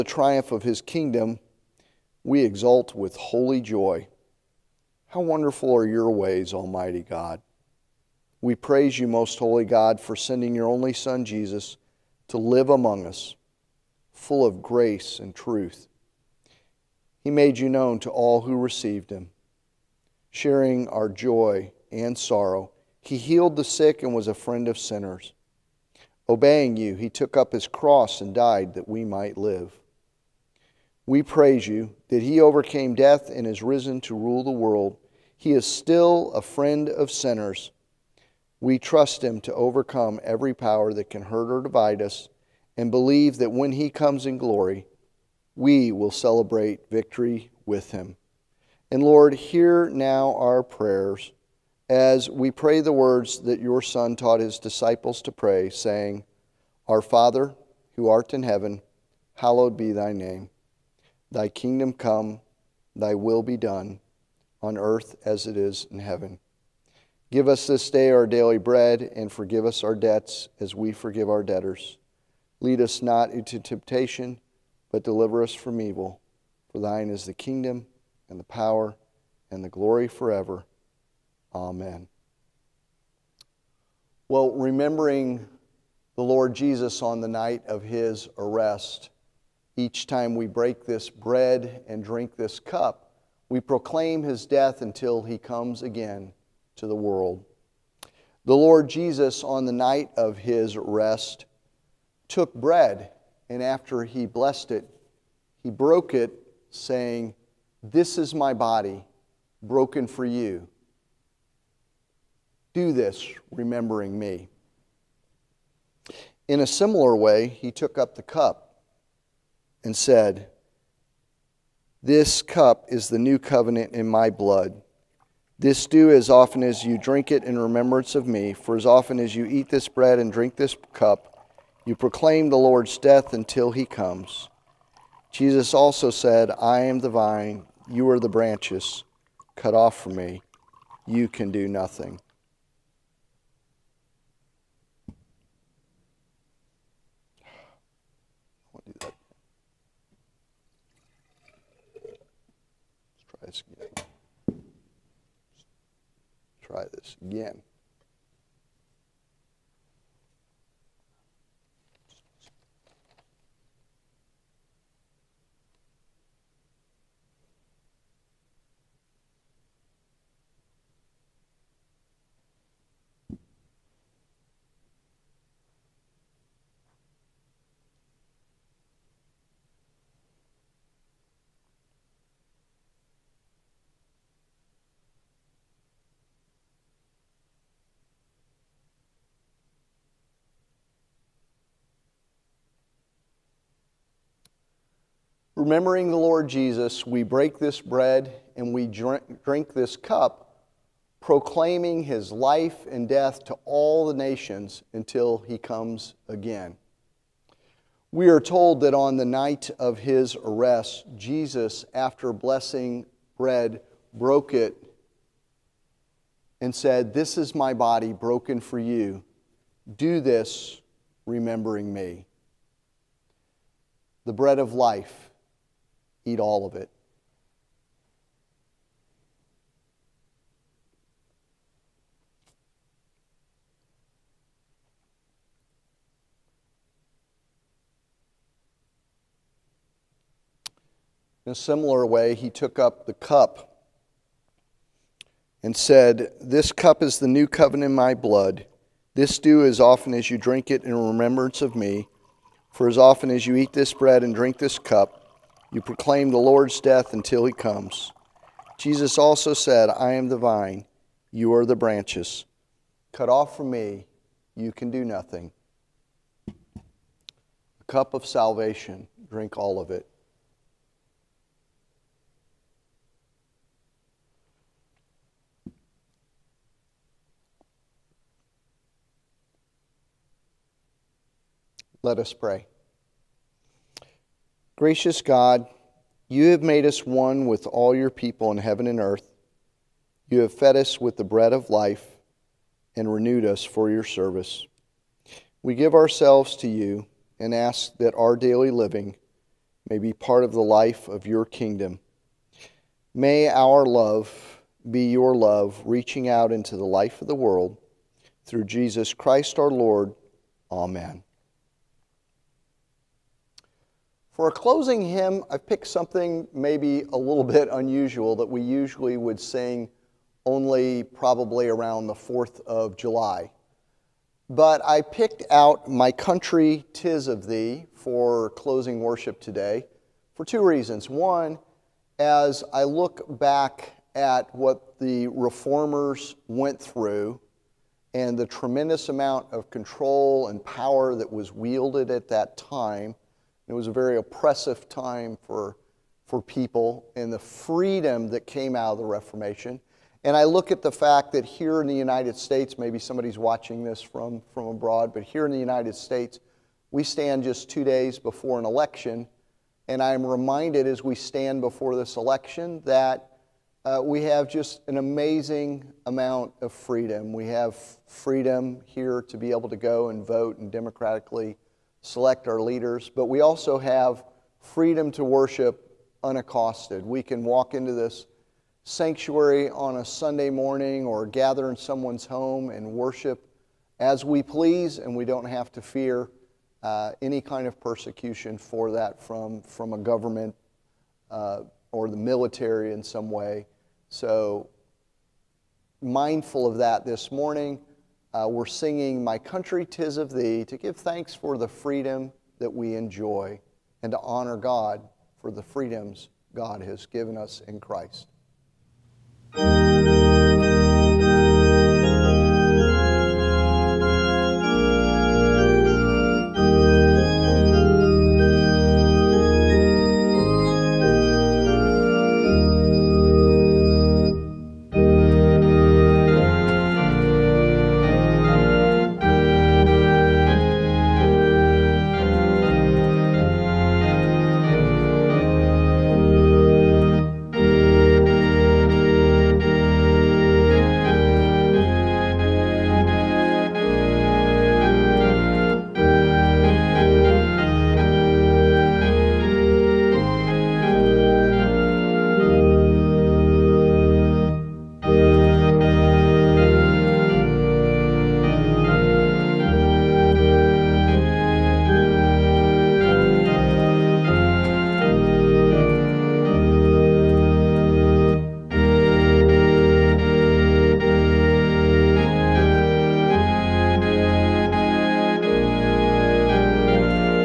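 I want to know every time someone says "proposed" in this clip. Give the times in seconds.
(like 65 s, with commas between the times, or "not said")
not said.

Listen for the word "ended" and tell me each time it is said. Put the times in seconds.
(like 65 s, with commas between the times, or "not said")
not said.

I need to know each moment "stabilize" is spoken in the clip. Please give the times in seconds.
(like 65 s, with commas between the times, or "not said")
not said.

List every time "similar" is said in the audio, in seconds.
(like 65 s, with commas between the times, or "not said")
116 s, 241 s.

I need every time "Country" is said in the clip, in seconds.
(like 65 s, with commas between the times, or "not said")
326 s, 399 s.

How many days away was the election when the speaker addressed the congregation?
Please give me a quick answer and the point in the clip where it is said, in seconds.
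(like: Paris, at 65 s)
2, at 357 s.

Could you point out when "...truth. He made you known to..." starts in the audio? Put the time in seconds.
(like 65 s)
15 s.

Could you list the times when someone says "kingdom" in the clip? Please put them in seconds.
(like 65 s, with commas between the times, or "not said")
0 s, 61 s, 77 s, 301 s.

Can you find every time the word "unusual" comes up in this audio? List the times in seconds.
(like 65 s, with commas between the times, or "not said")
317 s.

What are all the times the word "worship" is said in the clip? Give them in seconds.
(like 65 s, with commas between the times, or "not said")
329 s, 375 s, 382 s.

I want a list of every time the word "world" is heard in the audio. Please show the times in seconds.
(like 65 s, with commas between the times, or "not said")
34 s, 96 s, 307 s.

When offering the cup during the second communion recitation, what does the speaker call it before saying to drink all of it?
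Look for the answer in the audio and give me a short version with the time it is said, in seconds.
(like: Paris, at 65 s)
A cup of salvation, at 266 s.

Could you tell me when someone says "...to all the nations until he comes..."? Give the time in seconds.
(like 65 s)
203 s.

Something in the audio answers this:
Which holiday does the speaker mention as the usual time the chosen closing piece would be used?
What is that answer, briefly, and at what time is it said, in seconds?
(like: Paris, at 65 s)
4th of July, at 322 s.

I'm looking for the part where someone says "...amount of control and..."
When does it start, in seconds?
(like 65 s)
339 s.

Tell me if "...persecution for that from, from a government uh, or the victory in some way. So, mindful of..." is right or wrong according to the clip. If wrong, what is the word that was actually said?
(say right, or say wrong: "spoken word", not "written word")
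wrong: "military", not "victory".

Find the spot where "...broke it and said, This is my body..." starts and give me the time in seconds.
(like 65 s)
214 s.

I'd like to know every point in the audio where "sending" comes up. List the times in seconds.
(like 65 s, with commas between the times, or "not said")
10 s.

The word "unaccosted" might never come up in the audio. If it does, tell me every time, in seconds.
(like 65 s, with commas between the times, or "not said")
376 s.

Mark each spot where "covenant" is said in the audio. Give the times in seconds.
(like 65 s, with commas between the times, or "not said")
123 s, 247 s.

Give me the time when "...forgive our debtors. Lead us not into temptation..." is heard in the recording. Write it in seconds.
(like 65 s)
70 s.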